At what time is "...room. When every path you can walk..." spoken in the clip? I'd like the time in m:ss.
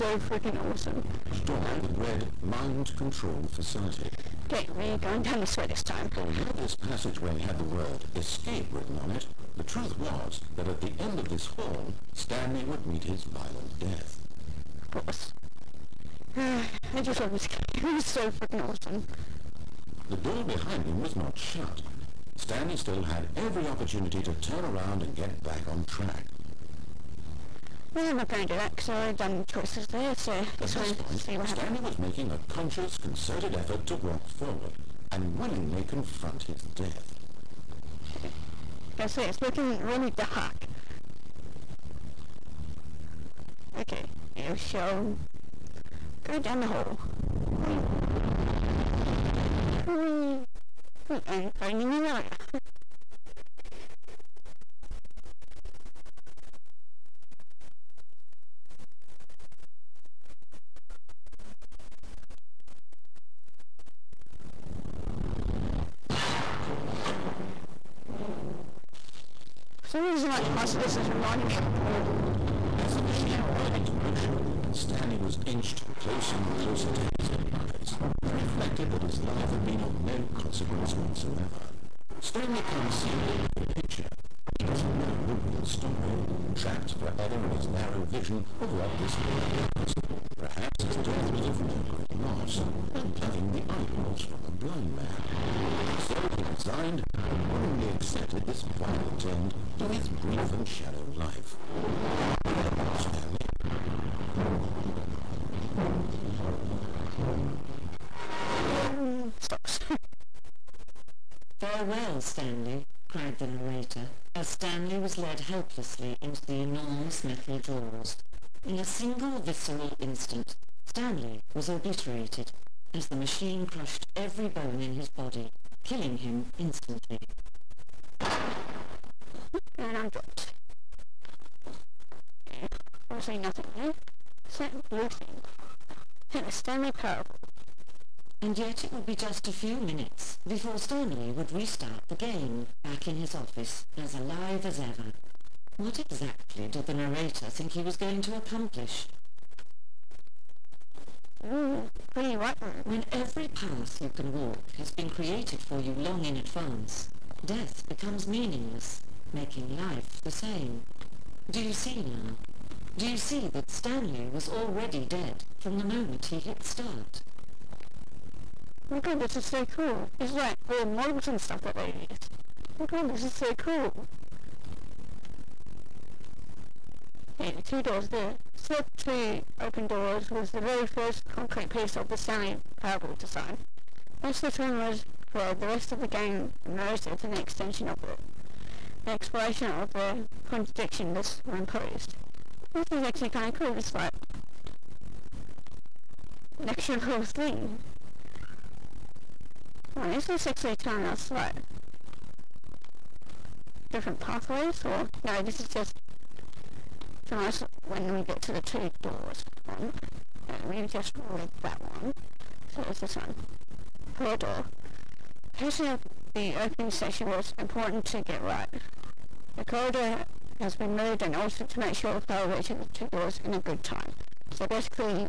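2:32.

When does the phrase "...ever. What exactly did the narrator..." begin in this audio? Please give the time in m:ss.
2:24.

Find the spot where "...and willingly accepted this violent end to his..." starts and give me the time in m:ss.
1:37.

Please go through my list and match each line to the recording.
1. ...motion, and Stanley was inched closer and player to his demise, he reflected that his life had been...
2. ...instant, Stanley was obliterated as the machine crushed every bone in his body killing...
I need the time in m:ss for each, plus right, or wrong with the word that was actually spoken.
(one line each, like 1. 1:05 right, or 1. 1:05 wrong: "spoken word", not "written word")
1. 1:13 wrong: "closer", not "player"
2. 2:00 right.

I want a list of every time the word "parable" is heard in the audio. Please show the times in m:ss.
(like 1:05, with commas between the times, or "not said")
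2:16, 3:02.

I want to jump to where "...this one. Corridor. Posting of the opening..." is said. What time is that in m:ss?
3:33.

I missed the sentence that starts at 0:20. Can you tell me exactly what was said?
The door behind him was not shut.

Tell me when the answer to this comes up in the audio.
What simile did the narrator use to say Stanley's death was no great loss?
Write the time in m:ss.
1:33.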